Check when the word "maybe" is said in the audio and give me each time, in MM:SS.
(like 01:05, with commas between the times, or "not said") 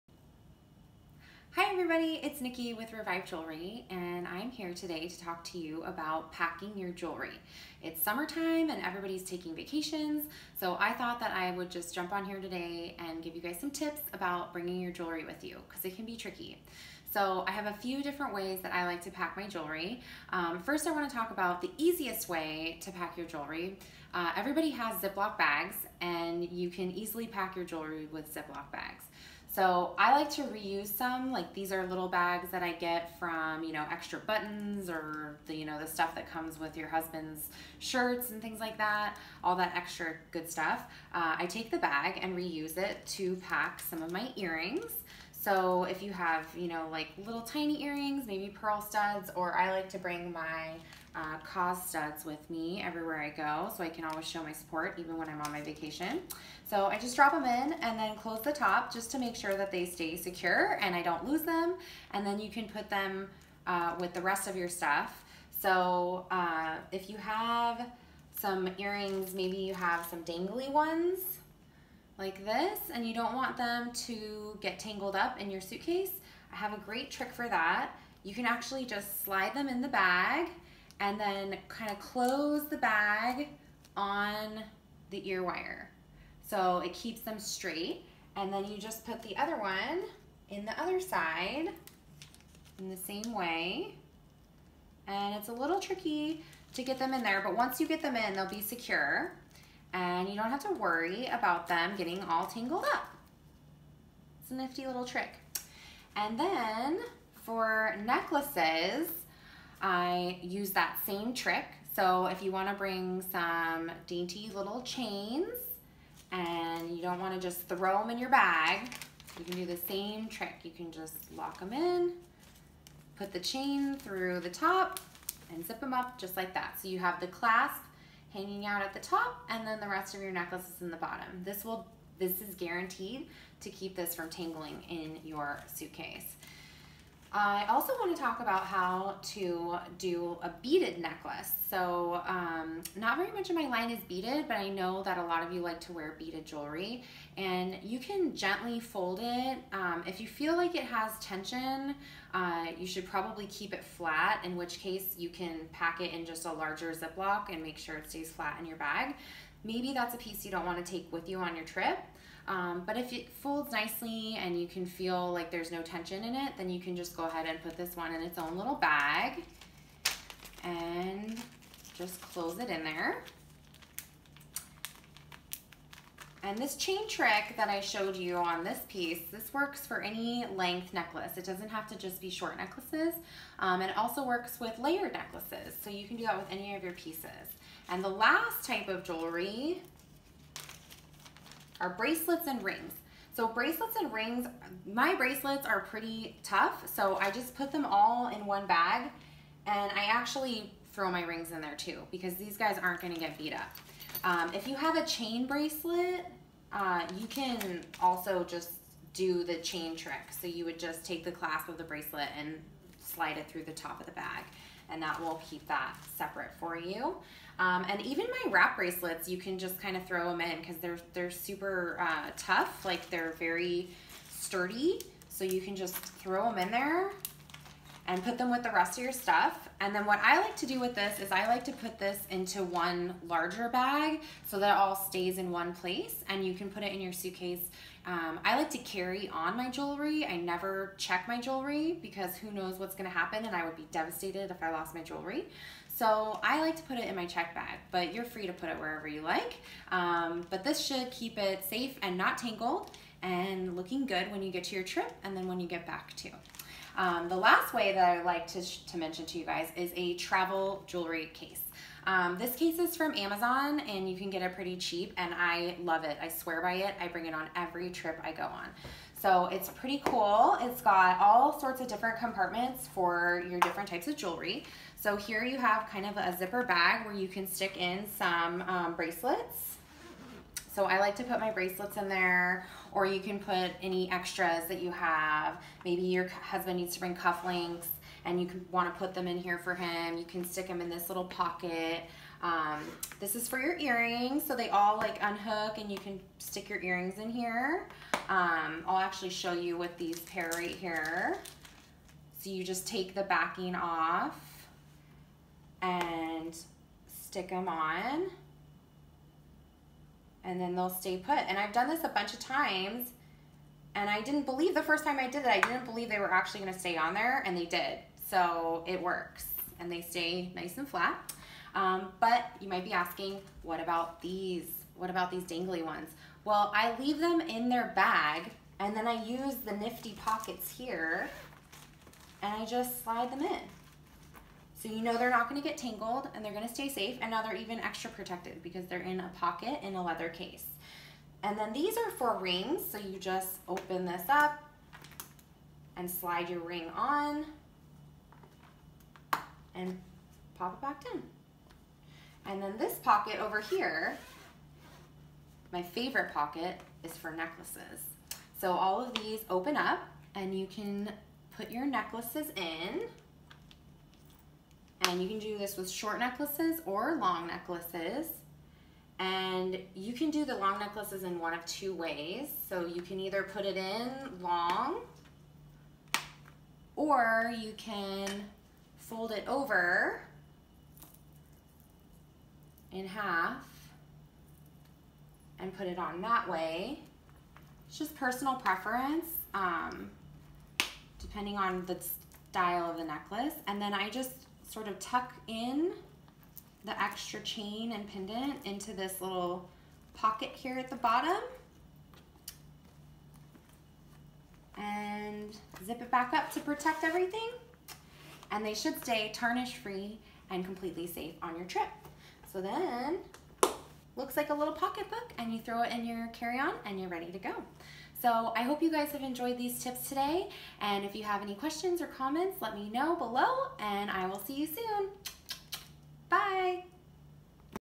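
00:48, 01:09, 02:39, 04:45.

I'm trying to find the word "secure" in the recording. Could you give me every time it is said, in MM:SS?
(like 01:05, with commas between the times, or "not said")
01:00, 01:38.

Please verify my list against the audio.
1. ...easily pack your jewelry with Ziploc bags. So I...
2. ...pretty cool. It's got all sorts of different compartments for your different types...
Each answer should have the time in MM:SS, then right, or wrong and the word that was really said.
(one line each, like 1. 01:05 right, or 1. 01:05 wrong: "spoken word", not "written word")
1. 00:26 right
2. 04:29 right.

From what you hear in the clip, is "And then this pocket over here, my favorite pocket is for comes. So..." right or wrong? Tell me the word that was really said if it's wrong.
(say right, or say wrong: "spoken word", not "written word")
wrong: "necklaces", not "comes".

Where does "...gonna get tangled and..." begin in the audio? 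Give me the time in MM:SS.
05:35.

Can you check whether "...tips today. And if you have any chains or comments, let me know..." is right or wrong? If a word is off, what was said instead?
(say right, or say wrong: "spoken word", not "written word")
wrong: "questions", not "chains".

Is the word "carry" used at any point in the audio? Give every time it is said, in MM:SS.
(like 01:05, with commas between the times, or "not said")
03:58, 06:56.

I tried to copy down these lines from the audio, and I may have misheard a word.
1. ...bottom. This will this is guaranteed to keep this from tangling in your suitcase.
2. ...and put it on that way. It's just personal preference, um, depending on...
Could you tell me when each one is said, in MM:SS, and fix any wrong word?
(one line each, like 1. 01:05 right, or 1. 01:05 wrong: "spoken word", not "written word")
1. 02:10 right
2. 06:25 right.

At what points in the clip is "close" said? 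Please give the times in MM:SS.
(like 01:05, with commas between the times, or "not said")
00:58, 01:21, 02:52.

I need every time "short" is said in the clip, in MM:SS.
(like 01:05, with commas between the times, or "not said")
03:02, 06:05.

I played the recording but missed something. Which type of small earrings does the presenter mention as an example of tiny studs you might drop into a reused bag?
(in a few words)
pearl studs.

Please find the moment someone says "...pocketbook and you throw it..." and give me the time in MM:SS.
06:54.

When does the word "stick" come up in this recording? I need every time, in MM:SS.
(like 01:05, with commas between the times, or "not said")
04:37, 04:50, 04:56, 05:07.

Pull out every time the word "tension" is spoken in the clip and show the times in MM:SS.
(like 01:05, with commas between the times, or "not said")
02:31, 02:45.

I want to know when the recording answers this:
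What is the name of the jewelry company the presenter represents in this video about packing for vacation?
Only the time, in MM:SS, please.
00:02.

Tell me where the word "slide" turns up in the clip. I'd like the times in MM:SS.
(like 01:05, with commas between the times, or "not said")
01:19, 03:33, 05:33, 05:46.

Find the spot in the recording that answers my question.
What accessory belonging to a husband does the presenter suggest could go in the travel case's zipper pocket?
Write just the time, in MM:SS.
04:47.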